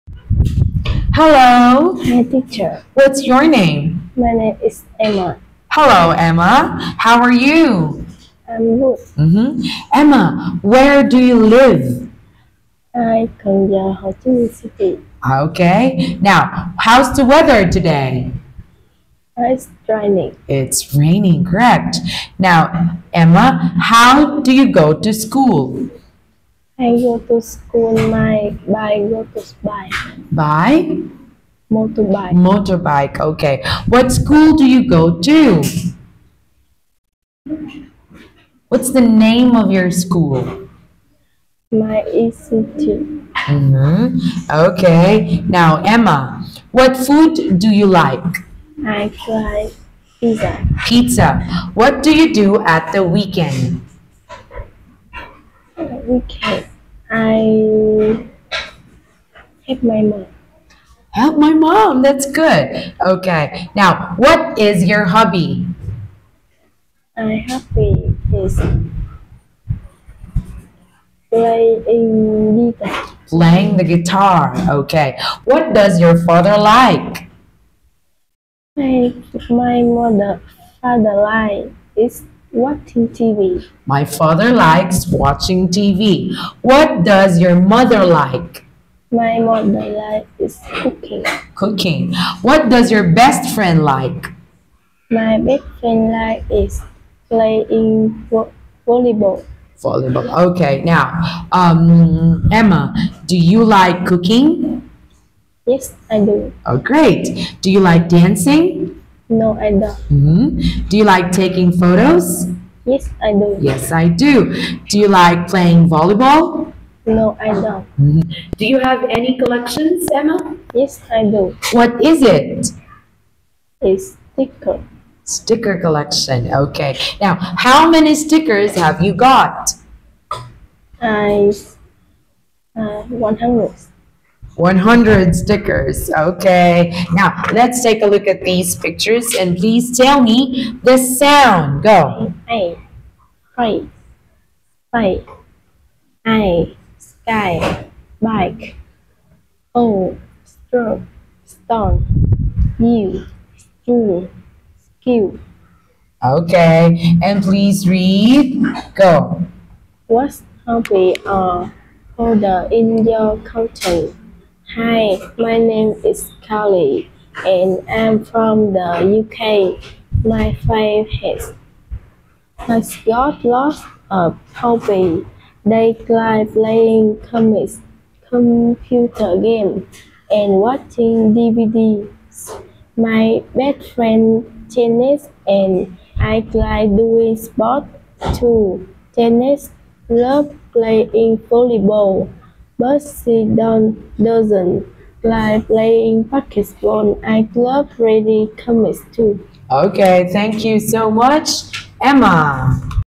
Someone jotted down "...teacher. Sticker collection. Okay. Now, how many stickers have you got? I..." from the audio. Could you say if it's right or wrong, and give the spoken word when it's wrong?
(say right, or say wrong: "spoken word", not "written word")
wrong: "sticker", not "teacher".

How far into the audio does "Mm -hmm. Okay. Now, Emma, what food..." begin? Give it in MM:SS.
00:43.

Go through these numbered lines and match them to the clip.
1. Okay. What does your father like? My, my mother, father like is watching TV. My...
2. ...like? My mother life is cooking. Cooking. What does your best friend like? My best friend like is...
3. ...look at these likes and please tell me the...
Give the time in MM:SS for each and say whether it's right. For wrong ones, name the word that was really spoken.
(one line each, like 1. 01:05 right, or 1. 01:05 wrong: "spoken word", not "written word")
1. 01:14 right
2. 01:28 right
3. 02:18 wrong: "pictures", not "likes".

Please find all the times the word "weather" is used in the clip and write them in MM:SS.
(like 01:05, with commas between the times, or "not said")
00:17.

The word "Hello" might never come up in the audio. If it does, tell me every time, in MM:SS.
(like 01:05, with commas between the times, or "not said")
00:01, 00:05.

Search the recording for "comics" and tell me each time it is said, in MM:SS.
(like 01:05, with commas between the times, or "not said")
02:57, 03:18.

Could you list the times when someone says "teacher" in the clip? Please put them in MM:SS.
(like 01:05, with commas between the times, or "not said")
00:02.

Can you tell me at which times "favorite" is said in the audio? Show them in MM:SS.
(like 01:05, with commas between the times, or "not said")
02:50.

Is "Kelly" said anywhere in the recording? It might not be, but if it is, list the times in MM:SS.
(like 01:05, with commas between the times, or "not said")
02:46.